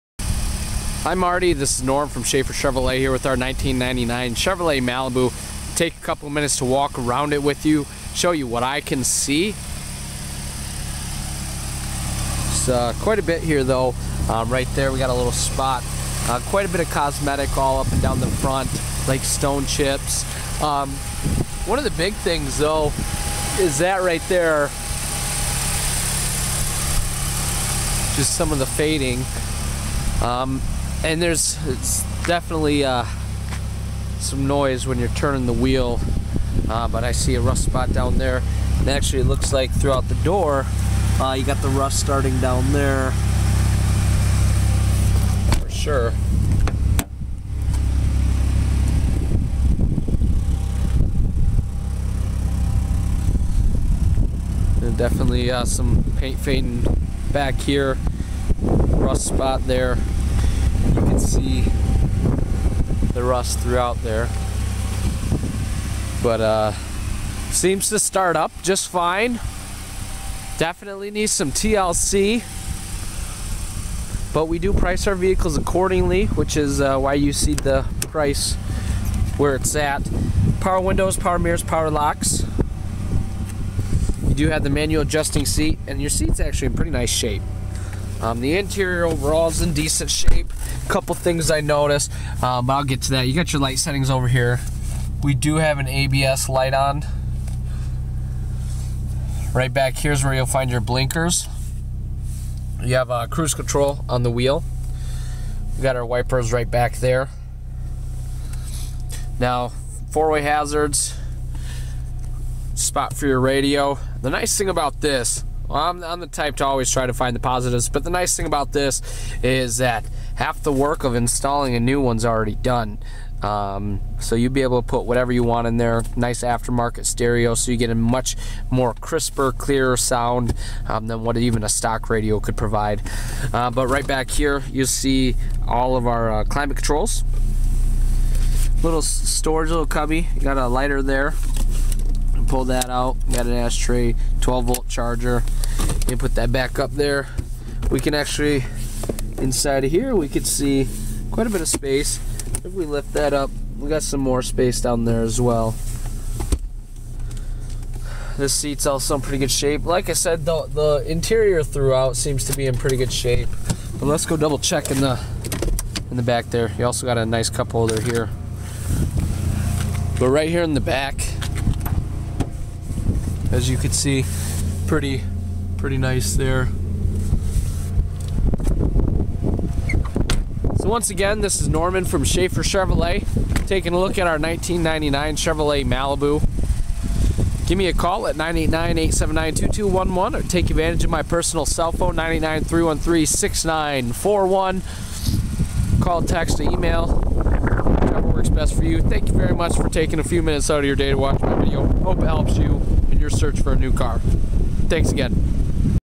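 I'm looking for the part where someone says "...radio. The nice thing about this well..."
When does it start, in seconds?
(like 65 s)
113 s.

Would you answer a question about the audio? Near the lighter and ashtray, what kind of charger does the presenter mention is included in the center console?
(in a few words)
12 volt.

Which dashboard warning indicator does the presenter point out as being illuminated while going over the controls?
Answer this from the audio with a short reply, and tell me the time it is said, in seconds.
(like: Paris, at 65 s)
ABS light, at 95 s.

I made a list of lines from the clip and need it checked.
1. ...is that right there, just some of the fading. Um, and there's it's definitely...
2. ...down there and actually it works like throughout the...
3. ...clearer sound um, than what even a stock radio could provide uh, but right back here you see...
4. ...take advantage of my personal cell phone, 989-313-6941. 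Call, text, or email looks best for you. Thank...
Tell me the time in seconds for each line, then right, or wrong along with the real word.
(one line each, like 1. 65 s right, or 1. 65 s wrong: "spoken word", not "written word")
1. 23 s right
2. 37 s wrong: "looks", not "works"
3. 129 s right
4. 190 s wrong: "works", not "looks".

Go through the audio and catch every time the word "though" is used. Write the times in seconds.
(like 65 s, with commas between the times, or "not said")
13 s, 22 s.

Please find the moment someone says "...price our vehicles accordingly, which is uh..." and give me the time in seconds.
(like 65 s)
74 s.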